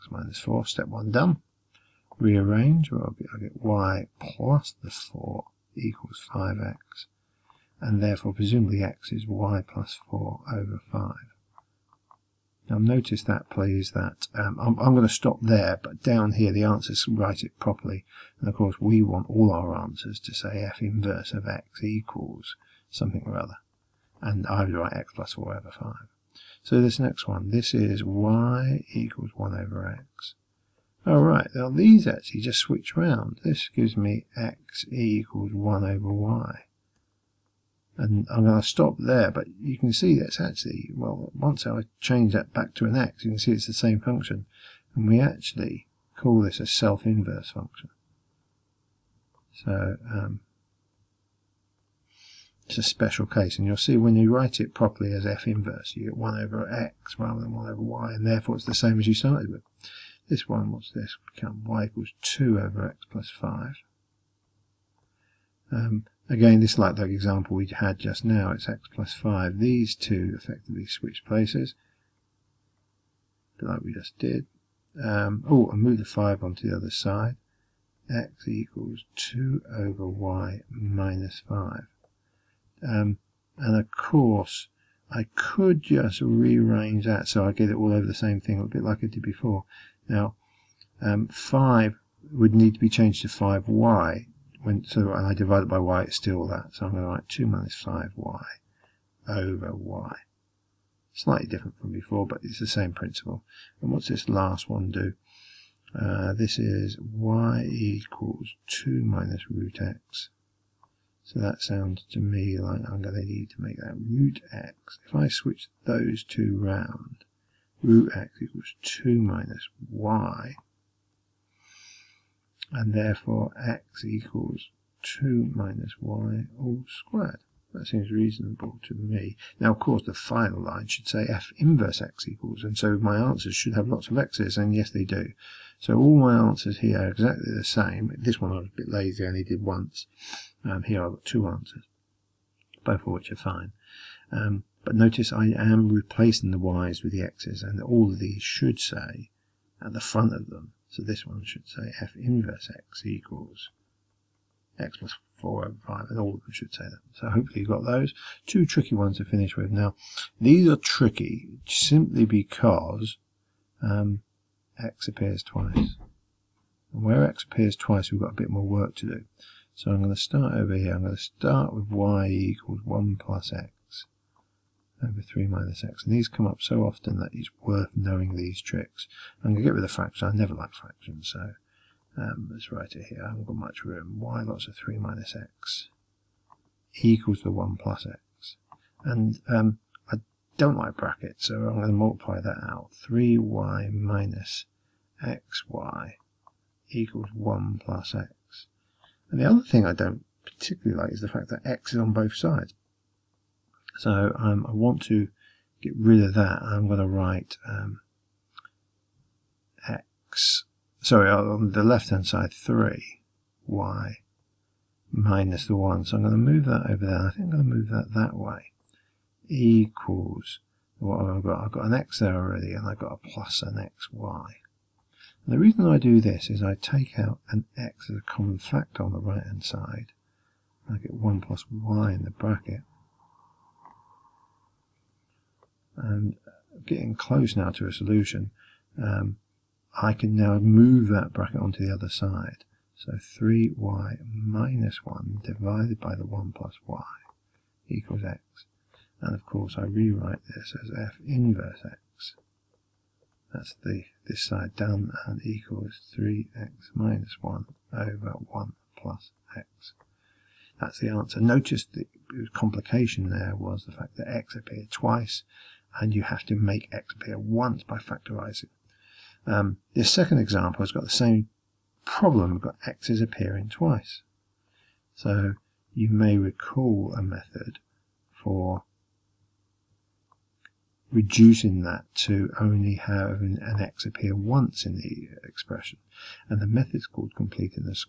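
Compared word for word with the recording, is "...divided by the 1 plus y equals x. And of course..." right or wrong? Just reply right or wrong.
right.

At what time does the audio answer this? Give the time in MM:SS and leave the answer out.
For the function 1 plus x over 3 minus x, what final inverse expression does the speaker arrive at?
04:16.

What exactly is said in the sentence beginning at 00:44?
And we actually call this a self-inverse function.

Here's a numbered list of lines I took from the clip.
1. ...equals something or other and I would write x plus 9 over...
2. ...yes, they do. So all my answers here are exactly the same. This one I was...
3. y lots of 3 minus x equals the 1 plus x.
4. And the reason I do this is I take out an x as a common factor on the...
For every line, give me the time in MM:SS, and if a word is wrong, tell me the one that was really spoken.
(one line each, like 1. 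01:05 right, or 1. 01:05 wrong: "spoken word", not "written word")
1. 00:21 wrong: "4", not "9"
2. 02:14 right
3. 03:04 right
4. 03:45 right.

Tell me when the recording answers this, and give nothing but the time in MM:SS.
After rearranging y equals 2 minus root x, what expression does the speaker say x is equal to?
02:05.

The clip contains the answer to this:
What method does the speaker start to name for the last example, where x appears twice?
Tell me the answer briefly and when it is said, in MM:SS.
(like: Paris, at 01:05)
completing, at 04:47.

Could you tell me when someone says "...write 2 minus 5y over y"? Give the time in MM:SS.
01:37.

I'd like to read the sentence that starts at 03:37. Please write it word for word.
I think I'm going to move that that way.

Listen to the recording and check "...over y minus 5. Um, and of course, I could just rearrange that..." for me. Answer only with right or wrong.
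right.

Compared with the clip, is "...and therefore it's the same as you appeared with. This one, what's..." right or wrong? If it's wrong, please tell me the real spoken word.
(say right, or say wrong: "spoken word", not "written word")
wrong: "started", not "appeared".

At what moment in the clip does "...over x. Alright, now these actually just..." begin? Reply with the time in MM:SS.
00:29.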